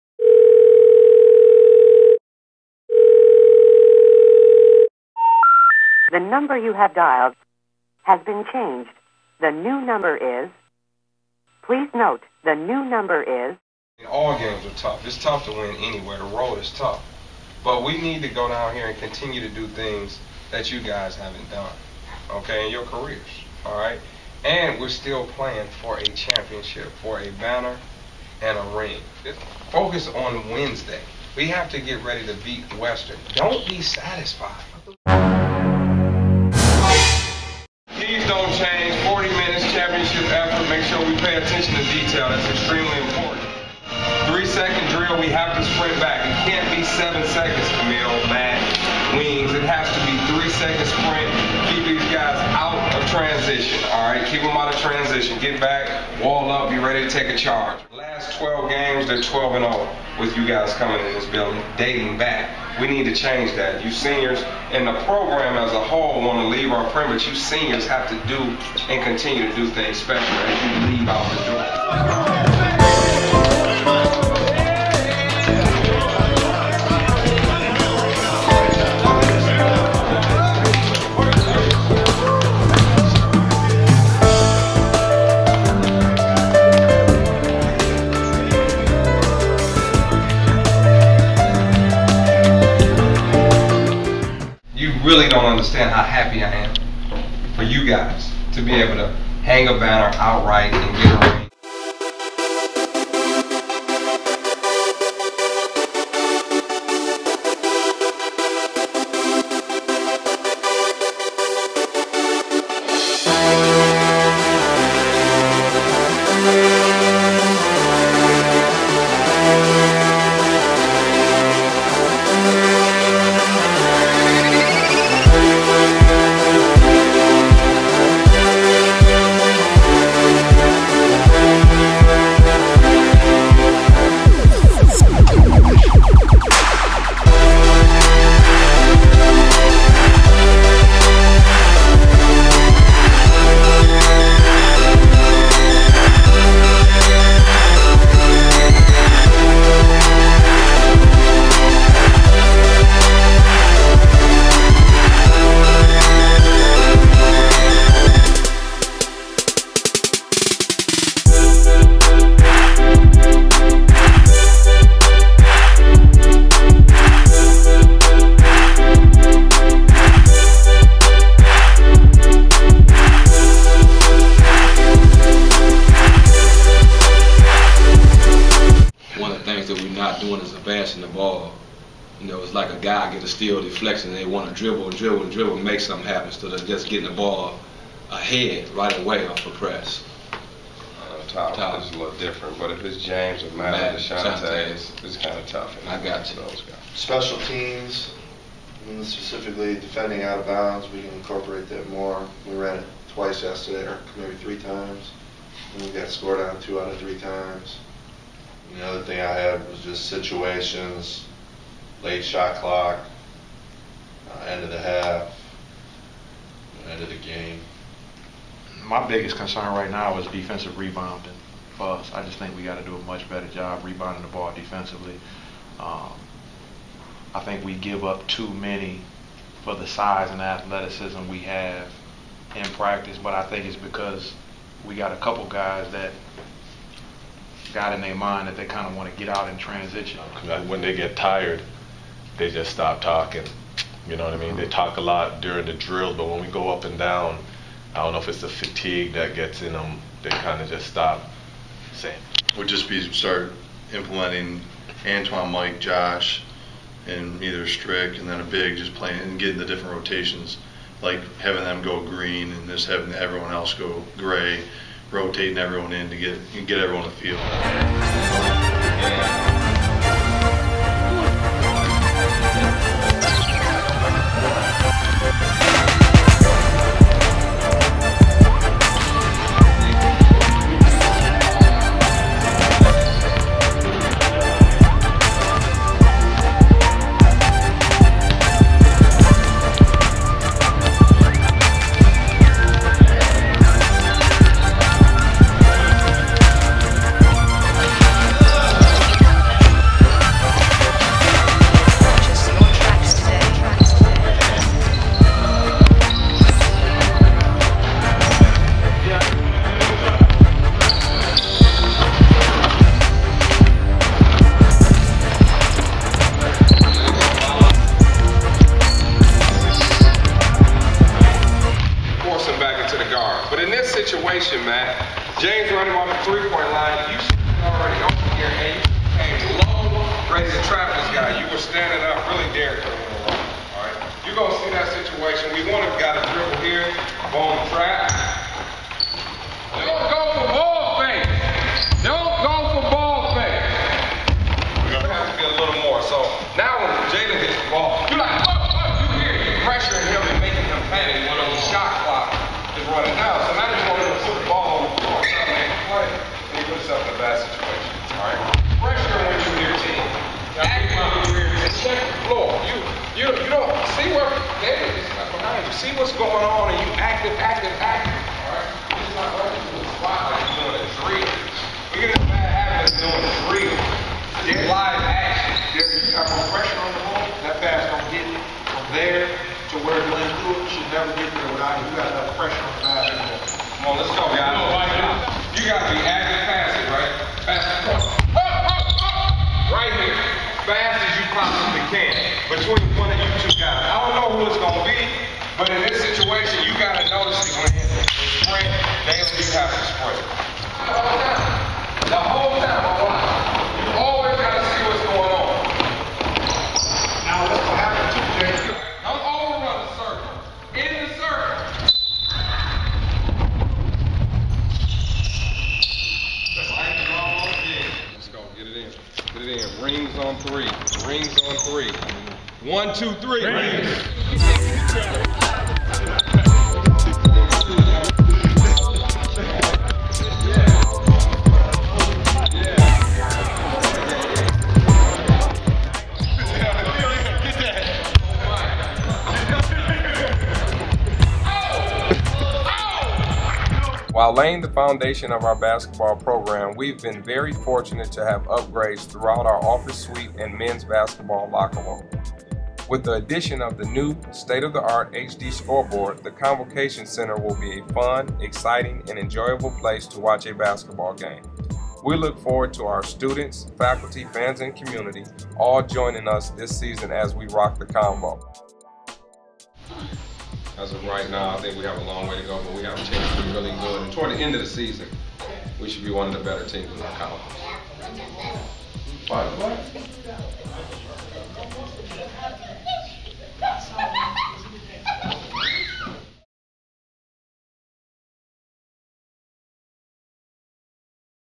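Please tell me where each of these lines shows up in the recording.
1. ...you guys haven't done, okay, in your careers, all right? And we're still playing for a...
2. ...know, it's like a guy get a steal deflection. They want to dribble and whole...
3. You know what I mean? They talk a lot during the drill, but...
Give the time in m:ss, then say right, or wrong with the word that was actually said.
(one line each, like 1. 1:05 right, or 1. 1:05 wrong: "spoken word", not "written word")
1. 0:20 right
2. 3:02 wrong: "dribble", not "whole"
3. 4:04 right.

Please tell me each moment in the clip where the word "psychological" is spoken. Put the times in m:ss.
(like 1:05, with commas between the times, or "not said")
not said.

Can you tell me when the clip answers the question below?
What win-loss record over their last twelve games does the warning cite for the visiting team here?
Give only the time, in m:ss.
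0:59.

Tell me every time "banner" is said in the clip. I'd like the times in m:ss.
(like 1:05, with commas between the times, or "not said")
0:27, 1:39.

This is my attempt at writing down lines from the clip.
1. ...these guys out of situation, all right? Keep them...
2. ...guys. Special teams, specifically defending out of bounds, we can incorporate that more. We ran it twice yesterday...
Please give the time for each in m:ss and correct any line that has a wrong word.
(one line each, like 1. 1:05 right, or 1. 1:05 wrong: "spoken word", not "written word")
1. 0:51 wrong: "transition", not "situation"
2. 3:16 right.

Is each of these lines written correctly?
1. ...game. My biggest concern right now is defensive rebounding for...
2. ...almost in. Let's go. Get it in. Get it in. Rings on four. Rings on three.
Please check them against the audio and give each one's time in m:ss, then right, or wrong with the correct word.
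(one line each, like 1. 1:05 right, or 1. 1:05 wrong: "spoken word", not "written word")
1. 3:37 right
2. 6:57 wrong: "three", not "four".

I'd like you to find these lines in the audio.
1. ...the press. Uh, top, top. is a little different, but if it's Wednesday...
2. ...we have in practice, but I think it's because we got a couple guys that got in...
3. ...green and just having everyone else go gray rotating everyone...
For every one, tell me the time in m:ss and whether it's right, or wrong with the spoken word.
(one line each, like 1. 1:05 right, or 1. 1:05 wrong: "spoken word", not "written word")
1. 3:09 wrong: "James", not "Wednesday"
2. 3:51 right
3. 4:22 right.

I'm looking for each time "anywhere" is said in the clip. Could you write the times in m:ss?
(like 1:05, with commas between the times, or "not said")
0:15.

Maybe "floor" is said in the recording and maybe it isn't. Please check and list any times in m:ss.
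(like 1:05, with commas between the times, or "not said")
5:54, 6:02.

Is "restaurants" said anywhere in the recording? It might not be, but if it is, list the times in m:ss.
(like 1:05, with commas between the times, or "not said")
not said.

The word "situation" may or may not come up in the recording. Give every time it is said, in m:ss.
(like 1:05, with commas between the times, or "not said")
3:30, 5:23, 5:34, 5:57, 6:35.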